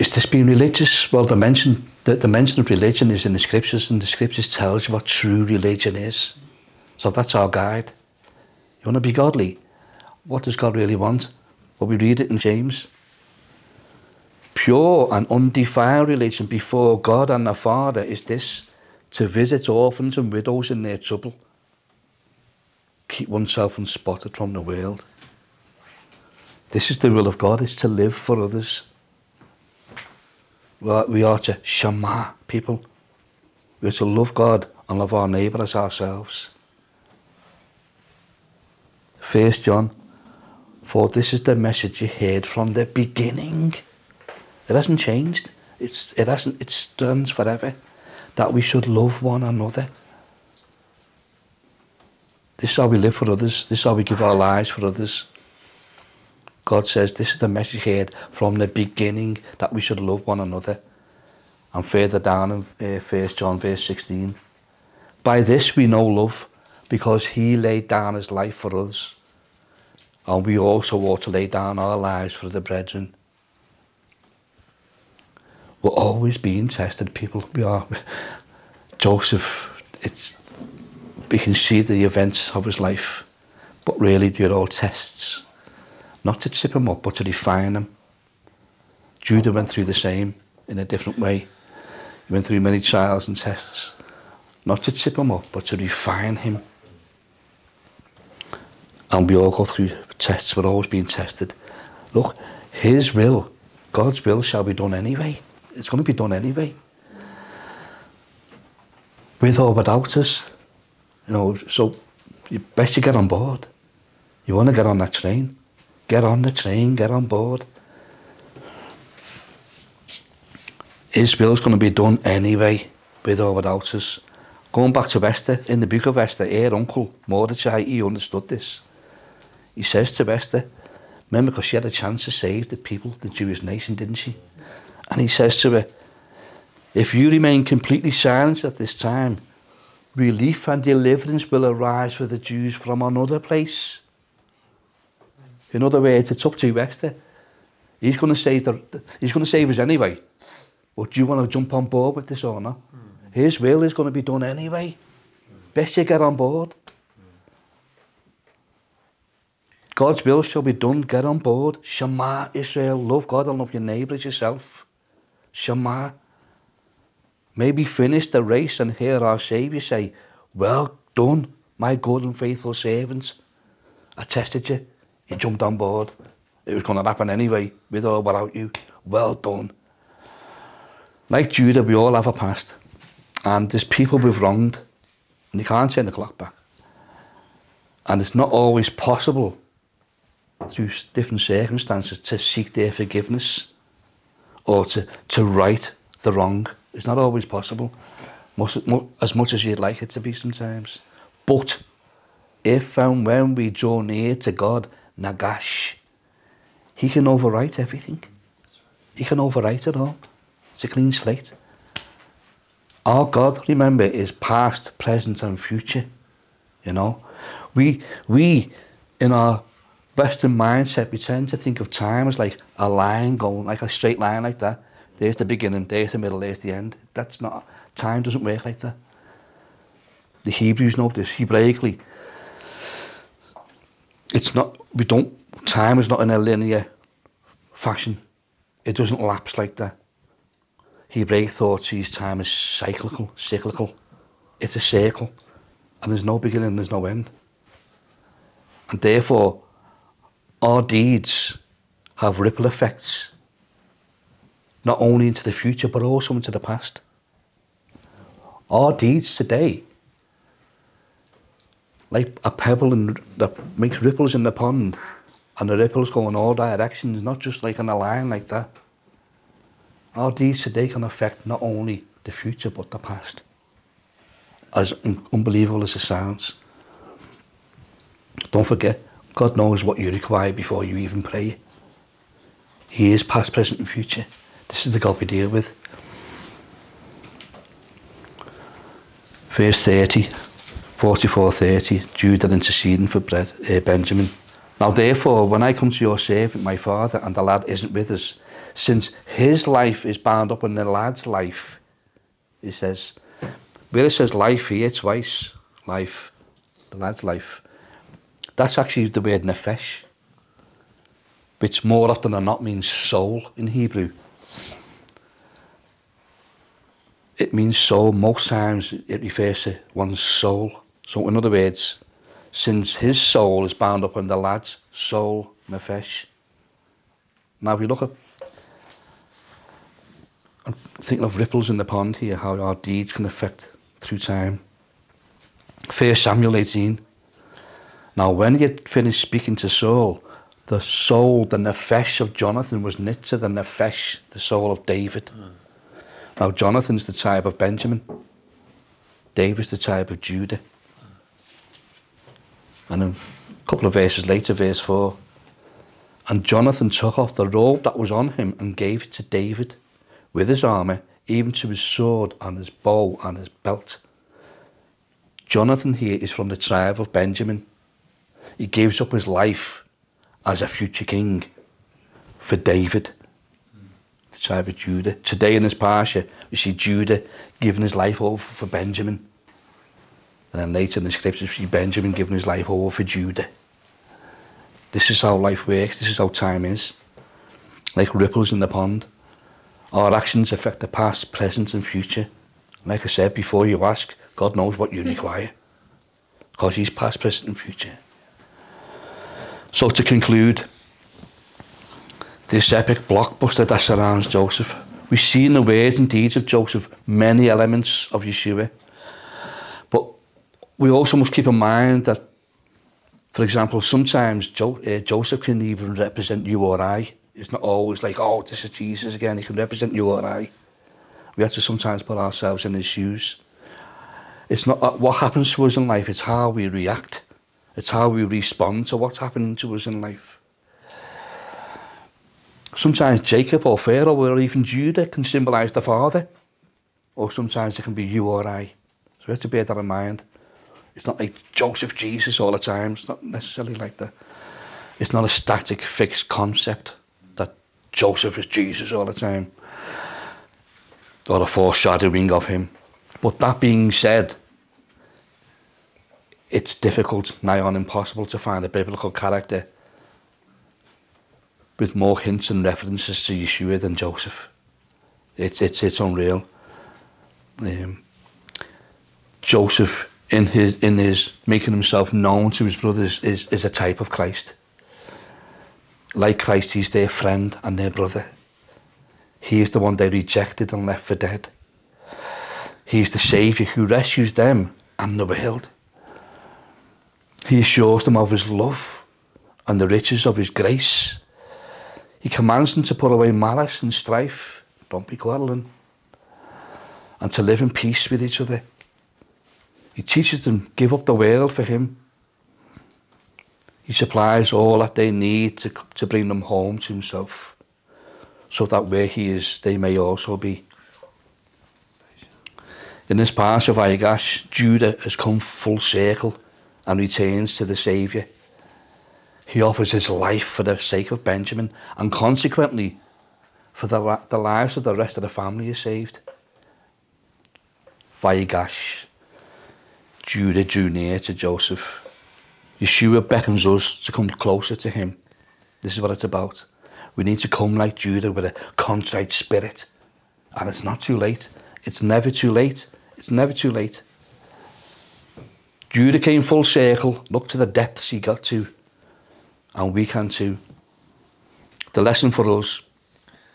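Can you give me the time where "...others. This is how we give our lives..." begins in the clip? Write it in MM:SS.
00:53.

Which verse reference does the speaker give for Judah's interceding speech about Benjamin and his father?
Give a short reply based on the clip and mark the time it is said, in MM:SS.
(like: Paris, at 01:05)
44:30, at 04:51.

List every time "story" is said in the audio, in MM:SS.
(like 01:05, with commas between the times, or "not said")
not said.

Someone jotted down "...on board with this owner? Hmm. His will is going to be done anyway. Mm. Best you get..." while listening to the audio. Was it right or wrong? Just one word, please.
right.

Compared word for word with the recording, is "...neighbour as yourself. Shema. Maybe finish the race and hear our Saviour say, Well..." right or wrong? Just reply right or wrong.
right.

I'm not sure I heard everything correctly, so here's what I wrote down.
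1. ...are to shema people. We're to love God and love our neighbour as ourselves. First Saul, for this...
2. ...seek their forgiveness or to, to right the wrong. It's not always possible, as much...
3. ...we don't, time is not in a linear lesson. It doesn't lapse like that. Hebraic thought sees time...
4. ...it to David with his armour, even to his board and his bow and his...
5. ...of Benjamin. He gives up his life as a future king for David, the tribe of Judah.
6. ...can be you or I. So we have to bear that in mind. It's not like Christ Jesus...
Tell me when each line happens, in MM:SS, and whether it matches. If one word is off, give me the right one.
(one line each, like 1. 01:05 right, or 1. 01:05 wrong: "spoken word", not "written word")
1. 00:31 wrong: "John", not "Saul"
2. 03:12 right
3. 03:54 wrong: "fashion", not "lesson"
4. 05:59 wrong: "sword", not "board"
5. 06:07 right
6. 07:17 wrong: "Joseph", not "Christ".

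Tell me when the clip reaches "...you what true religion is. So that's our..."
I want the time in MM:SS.
00:04.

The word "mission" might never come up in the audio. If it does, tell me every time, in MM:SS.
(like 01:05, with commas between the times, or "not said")
not said.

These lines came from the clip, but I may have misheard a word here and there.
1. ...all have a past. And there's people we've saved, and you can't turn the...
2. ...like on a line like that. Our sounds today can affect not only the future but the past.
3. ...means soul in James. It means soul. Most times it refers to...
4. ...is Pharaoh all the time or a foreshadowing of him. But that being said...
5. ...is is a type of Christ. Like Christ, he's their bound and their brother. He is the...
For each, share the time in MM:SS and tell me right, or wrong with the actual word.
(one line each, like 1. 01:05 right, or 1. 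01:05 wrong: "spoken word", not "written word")
1. 03:01 wrong: "wronged", not "saved"
2. 04:27 wrong: "deeds", not "sounds"
3. 05:12 wrong: "Hebrew", not "James"
4. 07:28 wrong: "Jesus", not "Pharaoh"
5. 07:53 wrong: "friend", not "bound".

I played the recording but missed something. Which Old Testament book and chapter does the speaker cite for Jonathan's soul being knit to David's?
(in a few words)
First Samuel 18.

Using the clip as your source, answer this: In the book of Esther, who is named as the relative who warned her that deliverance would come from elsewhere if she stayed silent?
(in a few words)
Mordechai.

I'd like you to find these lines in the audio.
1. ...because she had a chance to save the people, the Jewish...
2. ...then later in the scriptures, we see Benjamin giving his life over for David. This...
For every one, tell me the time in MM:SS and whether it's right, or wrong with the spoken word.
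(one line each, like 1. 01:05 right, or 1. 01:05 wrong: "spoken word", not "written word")
1. 02:11 right
2. 06:20 wrong: "Judah", not "David".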